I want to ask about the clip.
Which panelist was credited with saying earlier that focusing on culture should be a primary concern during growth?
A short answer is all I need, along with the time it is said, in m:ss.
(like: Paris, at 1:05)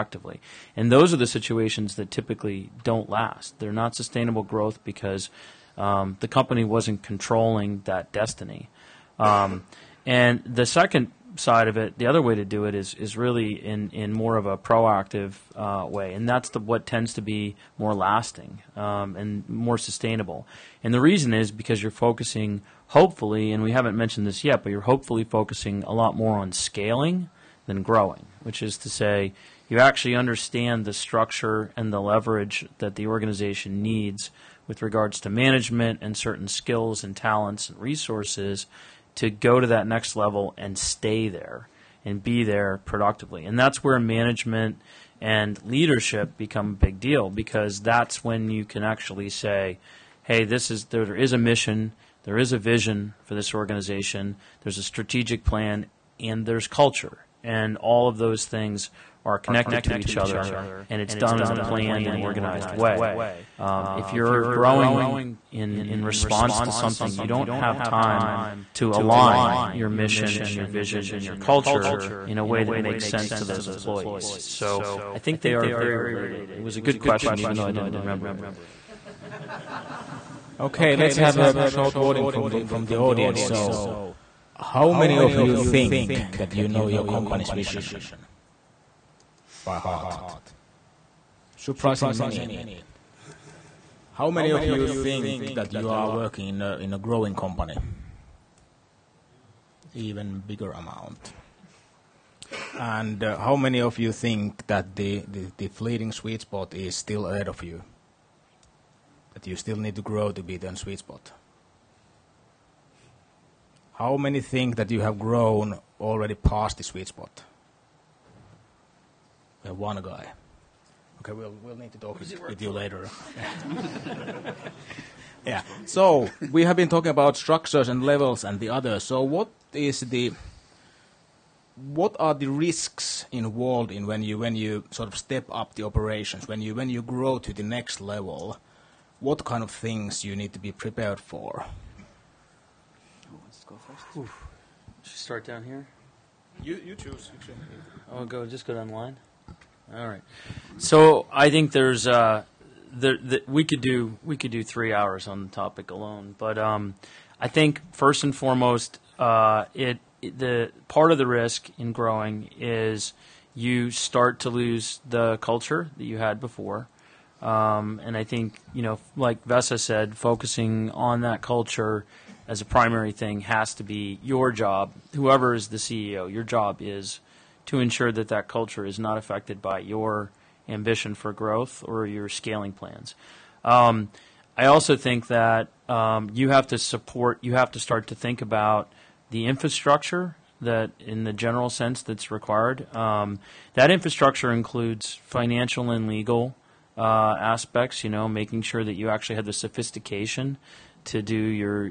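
Vesa, at 2:49.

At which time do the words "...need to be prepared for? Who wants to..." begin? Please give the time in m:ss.
2:20.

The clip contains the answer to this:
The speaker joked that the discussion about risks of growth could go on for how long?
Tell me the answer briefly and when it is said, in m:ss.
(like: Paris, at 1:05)
3 hours, at 2:34.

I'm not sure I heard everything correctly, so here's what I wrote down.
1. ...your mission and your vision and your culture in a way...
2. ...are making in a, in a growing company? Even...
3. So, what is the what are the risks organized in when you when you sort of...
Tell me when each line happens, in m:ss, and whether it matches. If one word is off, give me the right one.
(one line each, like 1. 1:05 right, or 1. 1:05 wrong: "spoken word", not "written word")
1. 1:09 right
2. 1:35 wrong: "working", not "making"
3. 2:09 wrong: "involved", not "organized".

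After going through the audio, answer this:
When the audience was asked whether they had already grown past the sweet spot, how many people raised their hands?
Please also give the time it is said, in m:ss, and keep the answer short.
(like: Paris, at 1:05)
1, at 1:59.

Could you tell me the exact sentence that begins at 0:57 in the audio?
And all of those things are connected to each other, and it's done in a planned and organized way.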